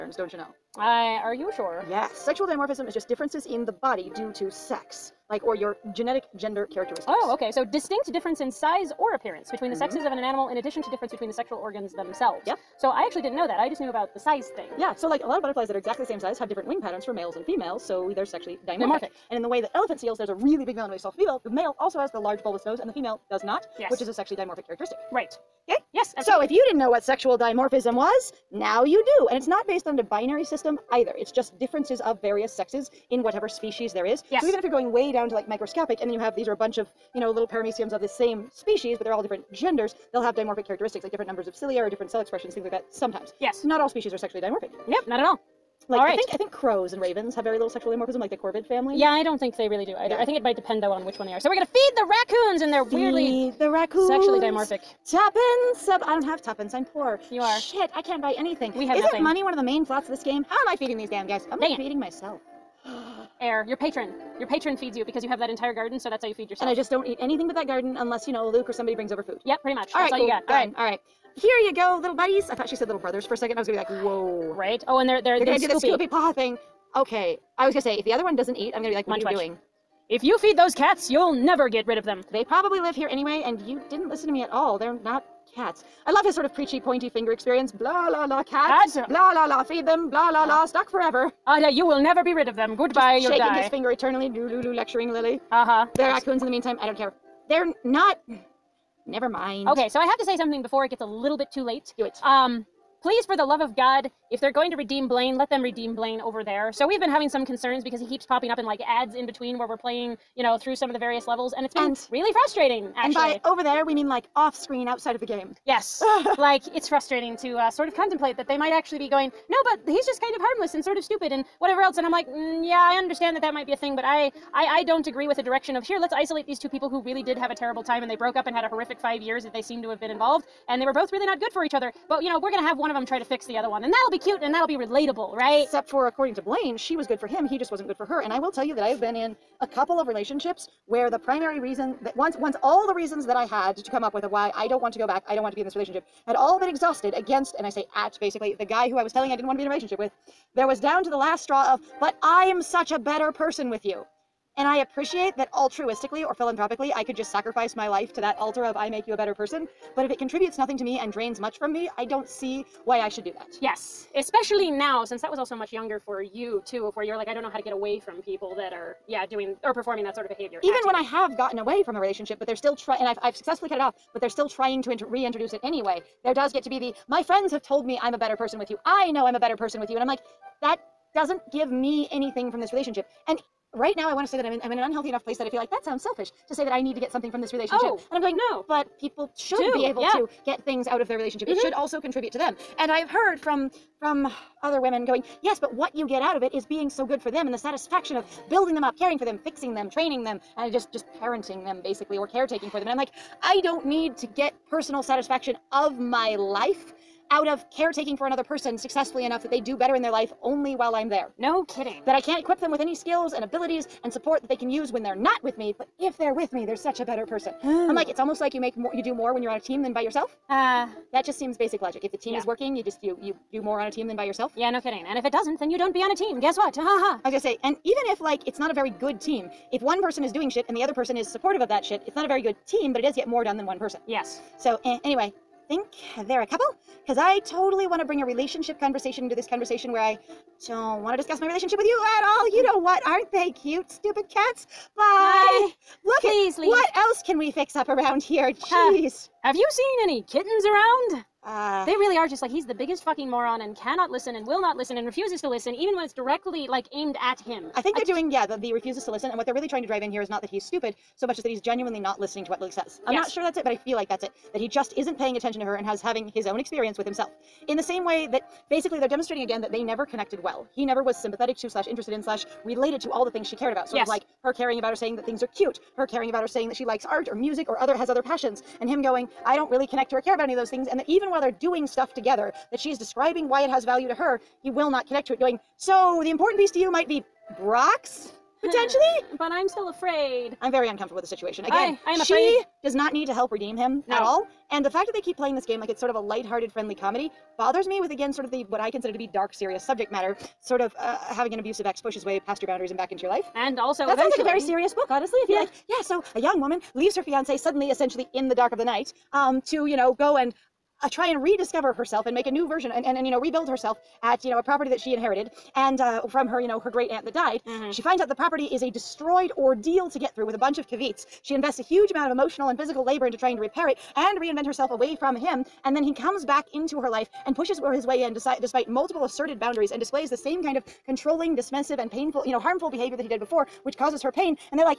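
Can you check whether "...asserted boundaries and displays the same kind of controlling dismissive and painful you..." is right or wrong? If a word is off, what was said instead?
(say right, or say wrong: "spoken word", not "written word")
right.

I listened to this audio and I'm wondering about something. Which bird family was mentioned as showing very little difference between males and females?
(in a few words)
Corvid family.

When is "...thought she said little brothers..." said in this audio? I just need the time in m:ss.
1:12.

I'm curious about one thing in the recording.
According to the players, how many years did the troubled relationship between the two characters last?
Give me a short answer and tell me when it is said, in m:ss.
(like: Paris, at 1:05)
5 years, at 2:08.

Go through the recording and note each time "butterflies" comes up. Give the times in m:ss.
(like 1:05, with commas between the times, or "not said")
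0:15.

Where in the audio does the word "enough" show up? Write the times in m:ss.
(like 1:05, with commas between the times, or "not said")
3:05, 3:29.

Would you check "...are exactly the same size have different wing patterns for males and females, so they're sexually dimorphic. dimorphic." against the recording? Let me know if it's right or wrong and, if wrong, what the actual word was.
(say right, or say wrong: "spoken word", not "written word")
right.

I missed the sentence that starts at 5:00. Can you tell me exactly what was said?
Sort of uh, having an abusive ex push his way past your boundaries and back into your life.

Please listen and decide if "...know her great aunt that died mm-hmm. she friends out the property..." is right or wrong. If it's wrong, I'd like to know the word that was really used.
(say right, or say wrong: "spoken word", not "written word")
wrong: "finds", not "friends".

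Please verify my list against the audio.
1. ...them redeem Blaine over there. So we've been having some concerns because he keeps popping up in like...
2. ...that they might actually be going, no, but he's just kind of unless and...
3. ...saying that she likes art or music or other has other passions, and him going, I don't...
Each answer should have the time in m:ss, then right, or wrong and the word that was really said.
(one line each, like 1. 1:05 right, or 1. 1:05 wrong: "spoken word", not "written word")
1. 1:45 right
2. 1:58 wrong: "harmless", not "unless"
3. 4:36 right.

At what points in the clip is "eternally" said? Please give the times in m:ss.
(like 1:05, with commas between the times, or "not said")
1:33.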